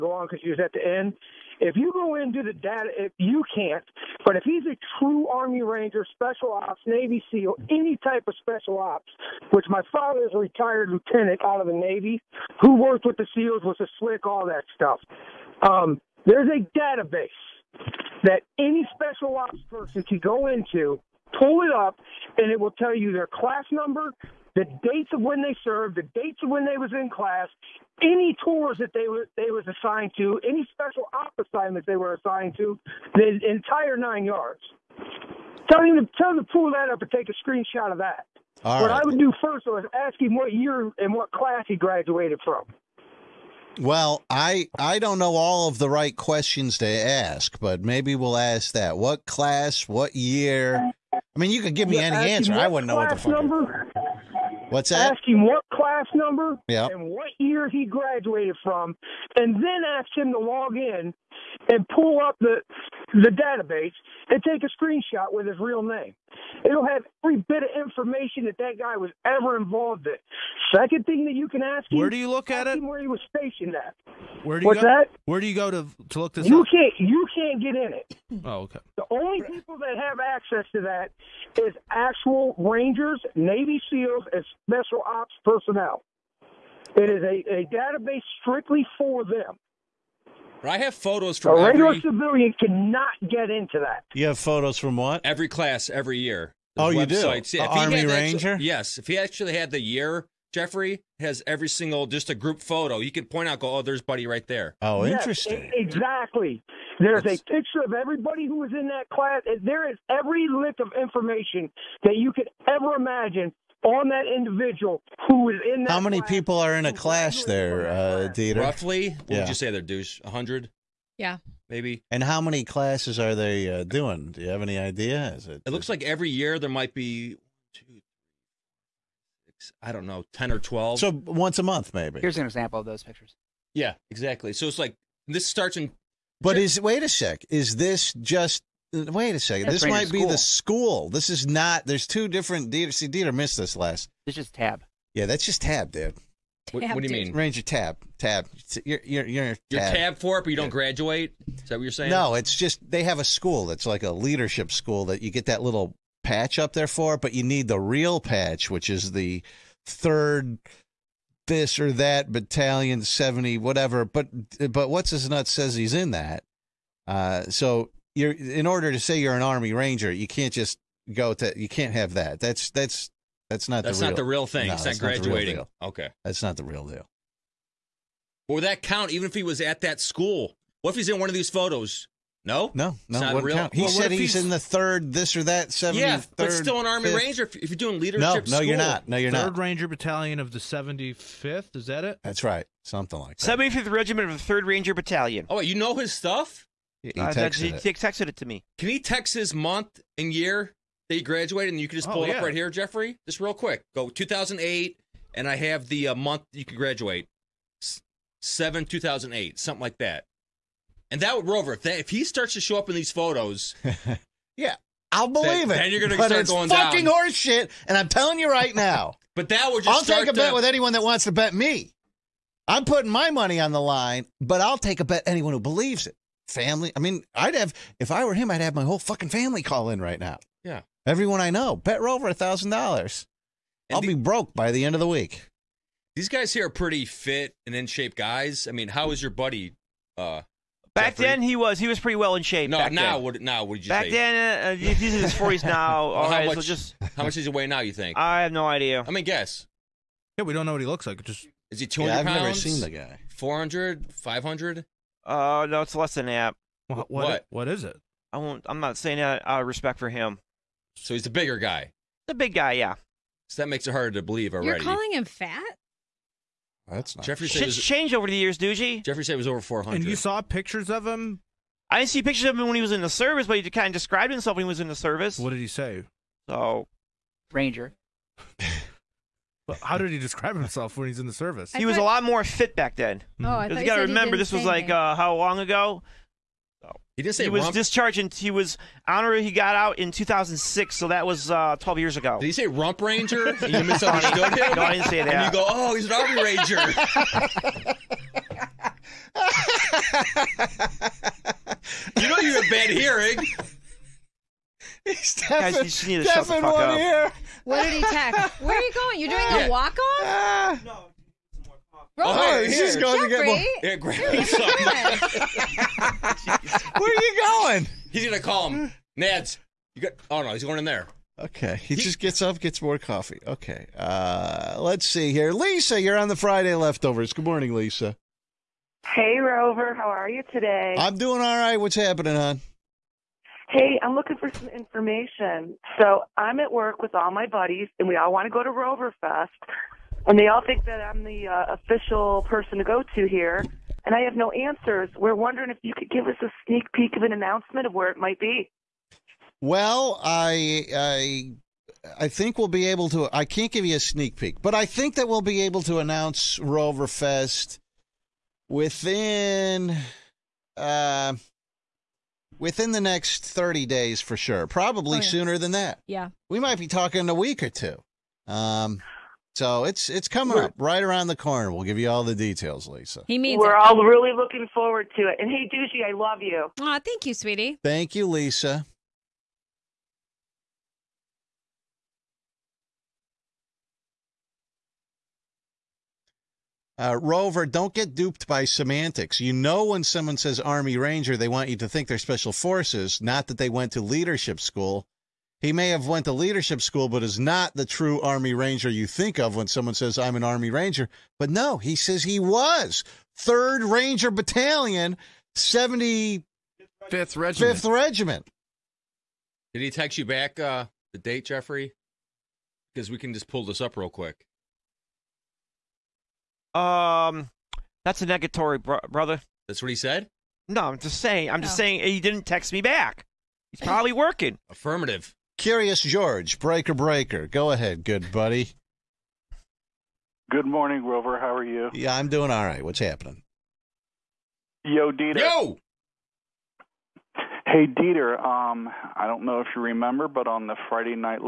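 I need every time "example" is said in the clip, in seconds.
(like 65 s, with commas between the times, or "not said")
132 s.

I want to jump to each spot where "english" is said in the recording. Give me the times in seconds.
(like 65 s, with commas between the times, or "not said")
not said.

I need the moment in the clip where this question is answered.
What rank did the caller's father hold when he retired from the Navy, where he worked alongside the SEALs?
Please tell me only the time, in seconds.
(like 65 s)
10 s.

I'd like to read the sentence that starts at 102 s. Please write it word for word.
You could point out, go, oh, there's Buddy right there.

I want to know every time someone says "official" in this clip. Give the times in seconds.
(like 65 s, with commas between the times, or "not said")
341 s.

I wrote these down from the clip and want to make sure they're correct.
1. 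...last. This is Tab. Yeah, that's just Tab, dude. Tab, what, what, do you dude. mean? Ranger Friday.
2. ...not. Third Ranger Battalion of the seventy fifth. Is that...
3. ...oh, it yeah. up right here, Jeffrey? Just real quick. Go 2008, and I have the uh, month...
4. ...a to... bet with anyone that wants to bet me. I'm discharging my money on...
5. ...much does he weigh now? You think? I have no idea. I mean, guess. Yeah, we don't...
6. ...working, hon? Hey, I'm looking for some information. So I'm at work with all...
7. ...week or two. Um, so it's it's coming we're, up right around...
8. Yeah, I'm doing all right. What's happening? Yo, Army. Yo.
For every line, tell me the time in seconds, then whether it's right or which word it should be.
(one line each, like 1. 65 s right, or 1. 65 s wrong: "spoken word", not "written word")
1. 143 s wrong: "Tab", not "Friday"
2. 189 s right
3. 202 s right
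4. 220 s wrong: "putting", not "discharging"
5. 247 s right
6. 331 s wrong: "happening", not "working"
7. 367 s right
8. 431 s wrong: "Dieter", not "Army".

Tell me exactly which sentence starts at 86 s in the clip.
It is a, a database strictly for them.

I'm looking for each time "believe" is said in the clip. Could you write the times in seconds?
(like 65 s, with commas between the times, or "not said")
215 s, 225 s, 264 s.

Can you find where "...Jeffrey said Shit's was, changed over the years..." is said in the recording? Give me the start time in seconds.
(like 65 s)
267 s.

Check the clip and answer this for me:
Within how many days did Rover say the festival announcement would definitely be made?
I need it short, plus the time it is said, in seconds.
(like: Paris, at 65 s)
30, at 363 s.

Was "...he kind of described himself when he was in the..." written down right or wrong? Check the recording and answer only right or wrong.
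right.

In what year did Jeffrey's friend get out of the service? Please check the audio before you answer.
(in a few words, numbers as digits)
2006.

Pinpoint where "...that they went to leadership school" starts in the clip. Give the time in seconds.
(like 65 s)
393 s.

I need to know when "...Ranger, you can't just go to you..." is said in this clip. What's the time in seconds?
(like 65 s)
169 s.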